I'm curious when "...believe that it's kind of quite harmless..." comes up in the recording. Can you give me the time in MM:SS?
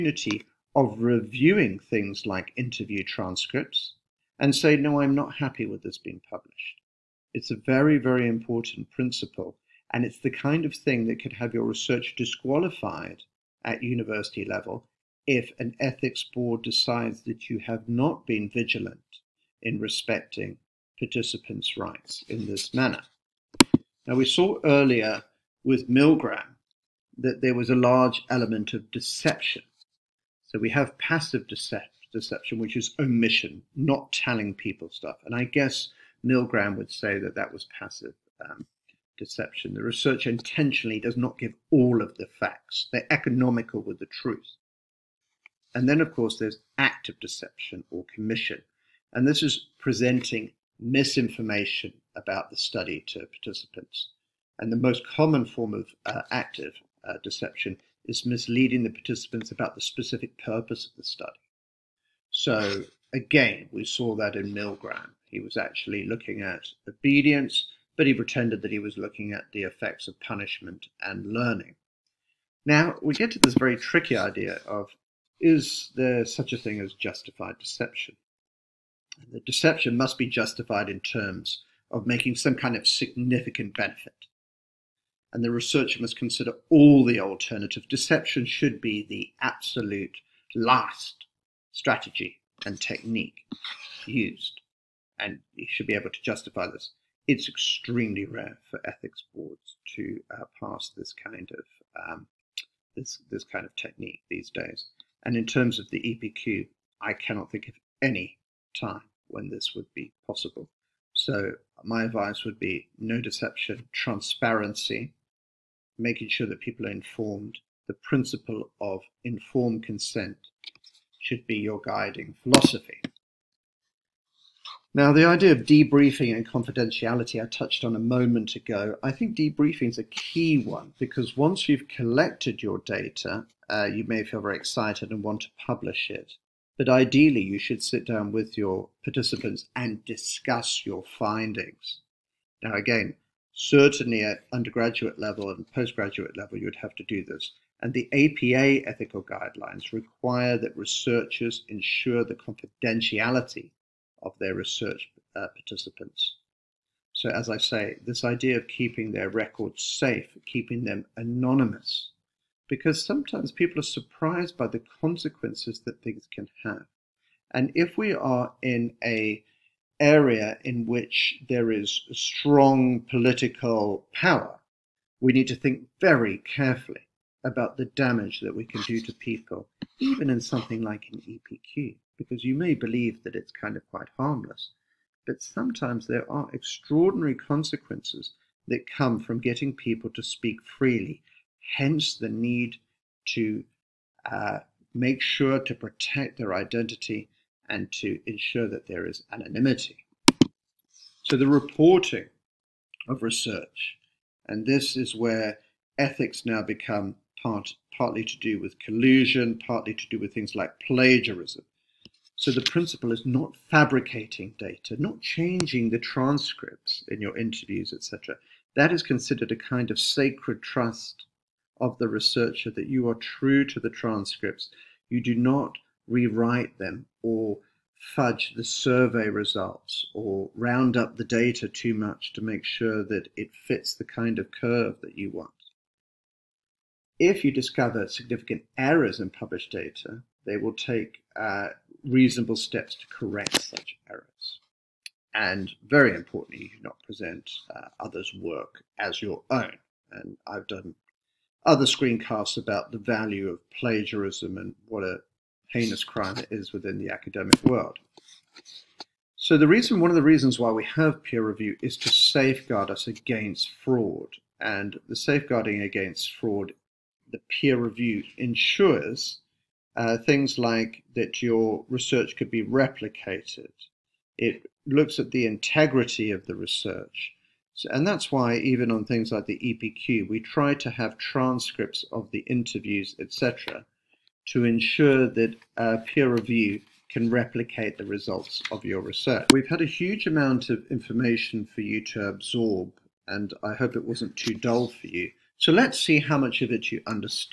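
03:02.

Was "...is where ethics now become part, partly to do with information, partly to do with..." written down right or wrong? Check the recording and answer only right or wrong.
wrong.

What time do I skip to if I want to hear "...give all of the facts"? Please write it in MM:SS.
00:41.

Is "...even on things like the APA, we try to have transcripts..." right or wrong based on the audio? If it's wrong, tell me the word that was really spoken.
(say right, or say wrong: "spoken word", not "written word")
wrong: "EPQ", not "APA".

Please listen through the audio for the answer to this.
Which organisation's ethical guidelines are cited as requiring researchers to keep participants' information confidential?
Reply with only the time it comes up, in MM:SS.
02:28.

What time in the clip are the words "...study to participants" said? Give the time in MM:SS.
00:52.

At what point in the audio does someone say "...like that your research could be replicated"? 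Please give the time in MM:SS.
04:30.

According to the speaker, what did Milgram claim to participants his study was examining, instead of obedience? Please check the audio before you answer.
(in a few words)
Effects of punishment and learning.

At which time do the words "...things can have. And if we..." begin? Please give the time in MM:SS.
02:46.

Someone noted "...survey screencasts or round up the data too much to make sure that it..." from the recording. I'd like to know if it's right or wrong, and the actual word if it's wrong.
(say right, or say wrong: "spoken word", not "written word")
wrong: "results", not "screencasts".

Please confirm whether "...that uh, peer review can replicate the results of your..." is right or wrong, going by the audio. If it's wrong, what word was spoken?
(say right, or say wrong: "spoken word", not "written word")
right.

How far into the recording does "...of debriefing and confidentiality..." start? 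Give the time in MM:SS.
02:05.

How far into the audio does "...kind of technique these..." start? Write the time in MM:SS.
01:43.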